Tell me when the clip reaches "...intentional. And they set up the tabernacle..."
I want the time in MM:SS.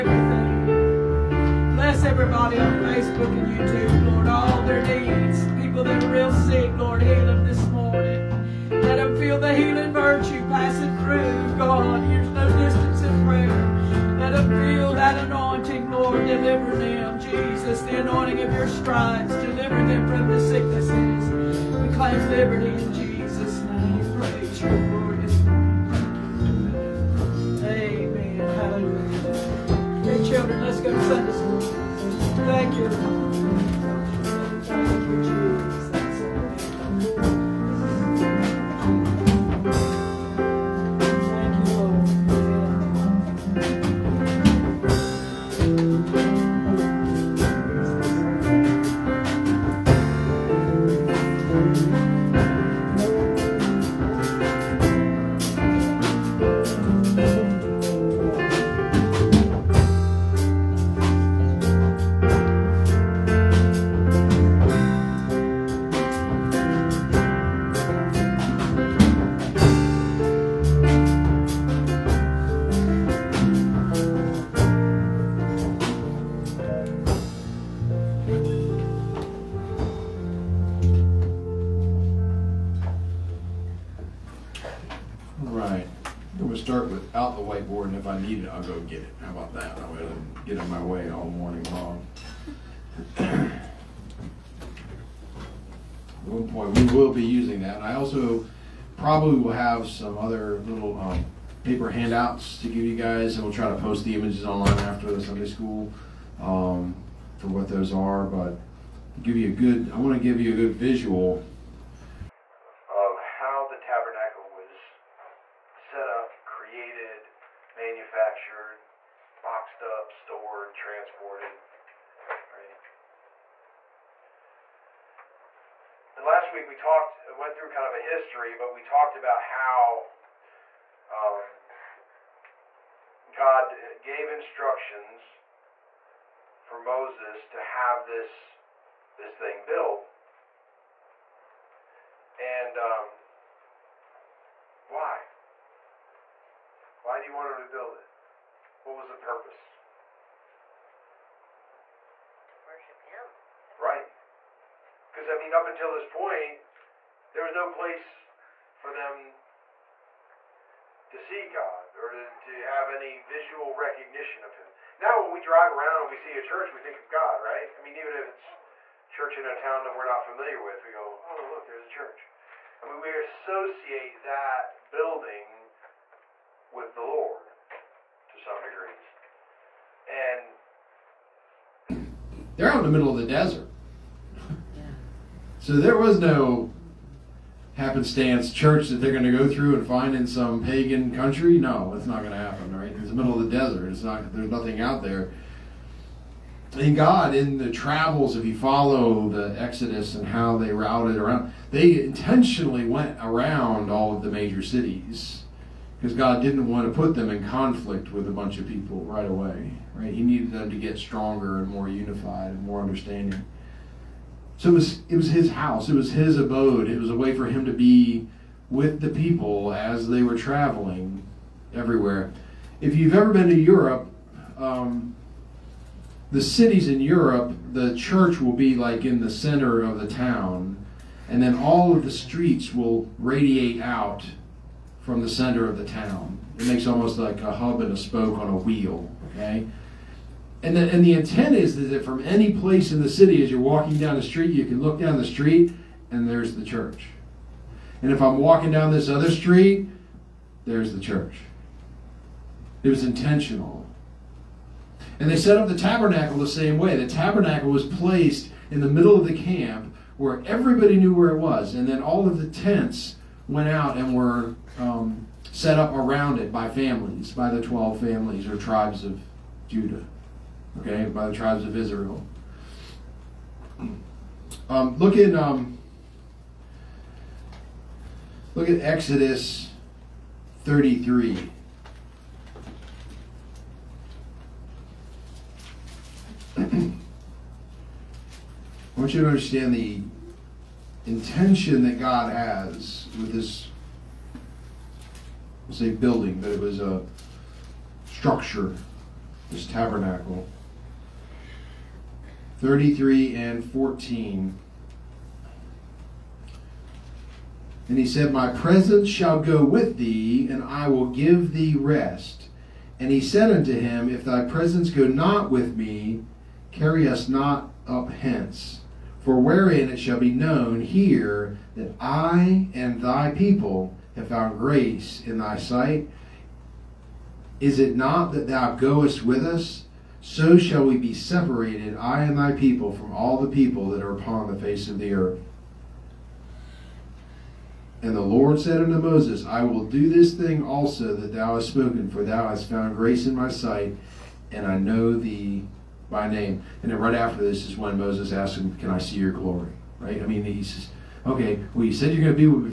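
04:13.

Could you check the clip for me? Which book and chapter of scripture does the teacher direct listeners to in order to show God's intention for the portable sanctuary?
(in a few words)
Exodus 33.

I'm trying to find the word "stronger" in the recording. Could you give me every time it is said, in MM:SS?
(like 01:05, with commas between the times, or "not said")
03:30.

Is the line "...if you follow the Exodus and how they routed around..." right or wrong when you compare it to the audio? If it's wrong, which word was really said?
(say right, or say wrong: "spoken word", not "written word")
right.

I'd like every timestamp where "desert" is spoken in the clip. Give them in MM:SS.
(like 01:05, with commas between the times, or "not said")
03:03, 03:13.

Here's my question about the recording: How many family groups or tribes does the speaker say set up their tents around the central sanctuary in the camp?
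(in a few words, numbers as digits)
12.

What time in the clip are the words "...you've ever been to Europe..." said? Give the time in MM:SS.
03:42.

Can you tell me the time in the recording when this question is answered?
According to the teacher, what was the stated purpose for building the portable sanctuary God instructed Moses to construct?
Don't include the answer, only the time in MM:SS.
02:32.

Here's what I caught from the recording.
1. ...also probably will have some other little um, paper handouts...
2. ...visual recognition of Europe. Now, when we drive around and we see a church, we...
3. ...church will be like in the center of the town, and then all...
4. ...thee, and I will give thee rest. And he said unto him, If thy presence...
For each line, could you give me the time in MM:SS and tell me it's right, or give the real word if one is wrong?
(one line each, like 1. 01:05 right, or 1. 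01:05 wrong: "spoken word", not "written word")
1. 01:37 right
2. 02:43 wrong: "Him", not "Europe"
3. 03:47 right
4. 05:09 right.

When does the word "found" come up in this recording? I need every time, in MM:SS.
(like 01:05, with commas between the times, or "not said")
05:24, 05:42.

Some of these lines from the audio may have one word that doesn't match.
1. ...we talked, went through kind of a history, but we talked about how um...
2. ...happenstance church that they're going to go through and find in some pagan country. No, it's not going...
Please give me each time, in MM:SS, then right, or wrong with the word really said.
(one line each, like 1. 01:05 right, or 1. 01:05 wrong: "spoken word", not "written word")
1. 02:06 right
2. 03:07 right.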